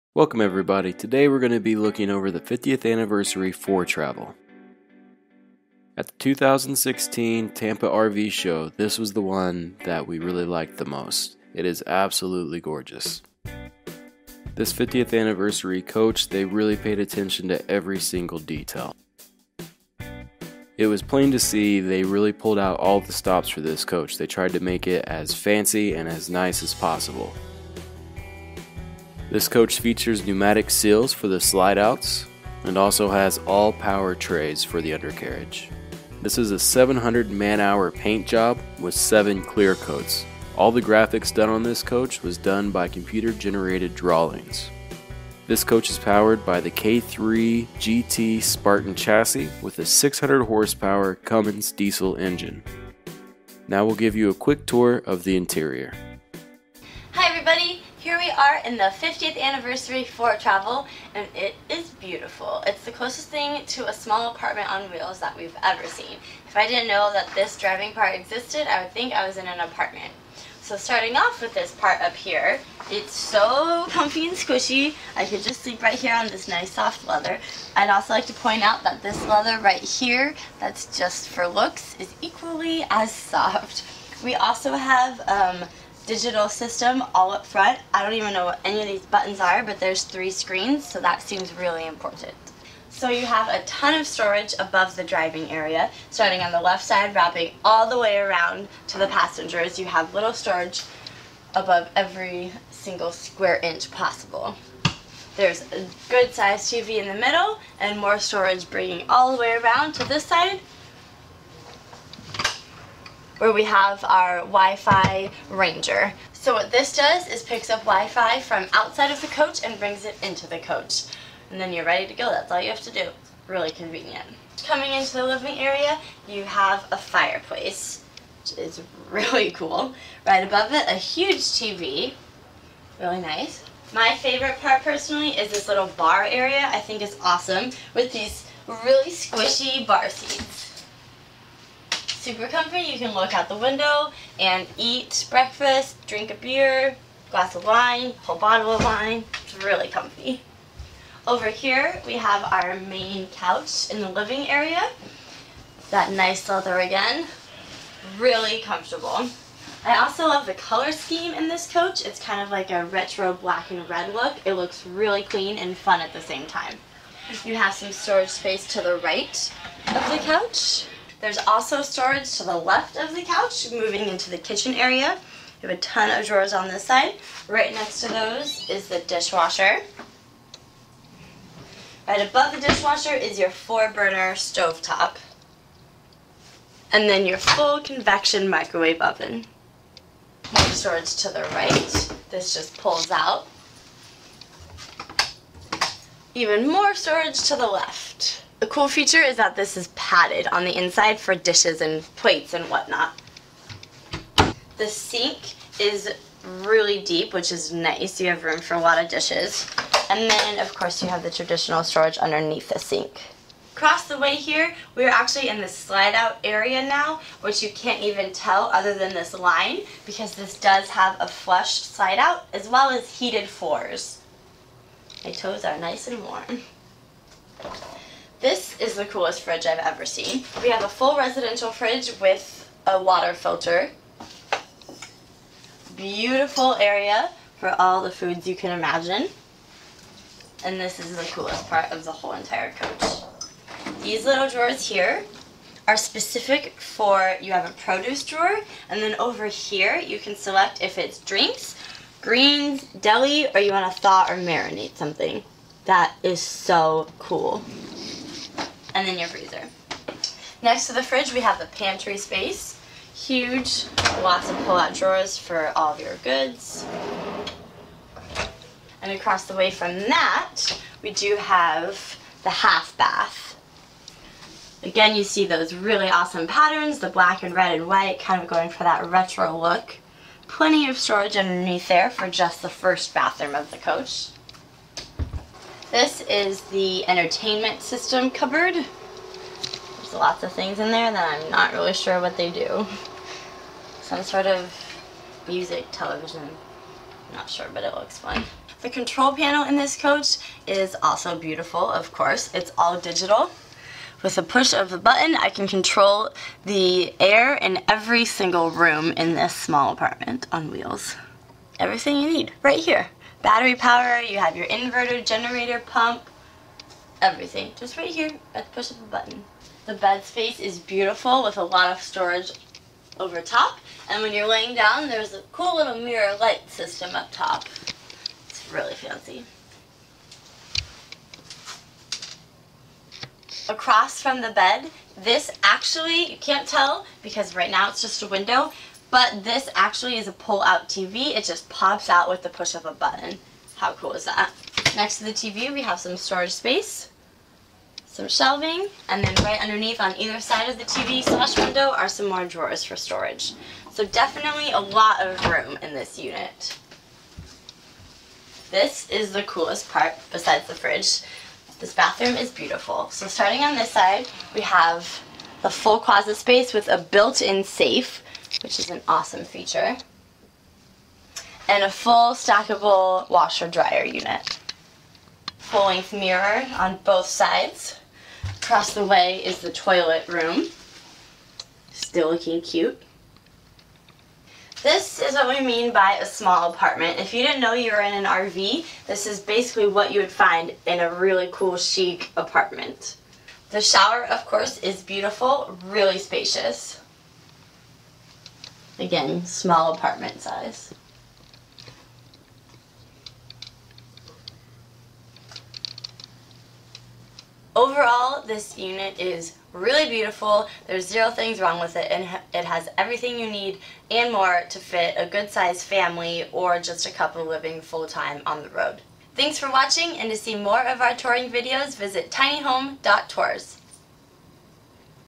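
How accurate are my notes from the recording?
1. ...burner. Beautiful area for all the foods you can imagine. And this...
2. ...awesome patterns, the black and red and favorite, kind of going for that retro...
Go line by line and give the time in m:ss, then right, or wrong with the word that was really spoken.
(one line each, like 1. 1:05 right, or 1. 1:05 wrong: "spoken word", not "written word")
1. 3:53 wrong: "filter", not "burner"
2. 4:36 wrong: "white", not "favorite".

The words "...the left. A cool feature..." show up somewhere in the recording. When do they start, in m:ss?
3:17.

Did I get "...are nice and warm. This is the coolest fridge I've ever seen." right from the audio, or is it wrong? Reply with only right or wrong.
right.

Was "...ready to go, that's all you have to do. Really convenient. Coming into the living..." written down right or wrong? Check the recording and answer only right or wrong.
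right.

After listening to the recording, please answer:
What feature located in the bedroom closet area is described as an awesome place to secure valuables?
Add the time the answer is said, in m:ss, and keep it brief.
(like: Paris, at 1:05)
built-in safe, at 6:06.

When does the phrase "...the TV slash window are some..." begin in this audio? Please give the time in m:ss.
5:50.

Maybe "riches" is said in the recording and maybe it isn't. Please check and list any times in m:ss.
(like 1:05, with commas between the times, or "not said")
not said.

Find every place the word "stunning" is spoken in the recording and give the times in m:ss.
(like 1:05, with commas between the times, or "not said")
not said.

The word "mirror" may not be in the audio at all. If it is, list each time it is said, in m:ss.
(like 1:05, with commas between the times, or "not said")
5:25, 6:16.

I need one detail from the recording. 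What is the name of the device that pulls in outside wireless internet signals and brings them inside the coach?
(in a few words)
Wi-Fi Ranger.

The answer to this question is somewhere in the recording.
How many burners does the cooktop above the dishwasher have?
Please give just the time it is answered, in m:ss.
3:03.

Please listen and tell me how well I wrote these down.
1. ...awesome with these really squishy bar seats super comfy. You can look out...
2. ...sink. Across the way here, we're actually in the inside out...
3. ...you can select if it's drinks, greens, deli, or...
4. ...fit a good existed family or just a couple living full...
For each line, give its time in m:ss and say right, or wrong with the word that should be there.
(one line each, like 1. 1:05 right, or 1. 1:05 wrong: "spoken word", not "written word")
1. 2:17 right
2. 3:32 wrong: "slide", not "inside"
3. 4:09 right
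4. 6:54 wrong: "sized", not "existed".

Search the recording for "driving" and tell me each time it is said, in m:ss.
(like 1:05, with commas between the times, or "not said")
1:07, 1:35.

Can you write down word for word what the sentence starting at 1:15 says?
I could just sleep right here on this nice soft leather.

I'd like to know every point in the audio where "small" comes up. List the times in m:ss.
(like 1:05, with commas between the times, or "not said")
1:03, 5:09, 6:26, 6:39.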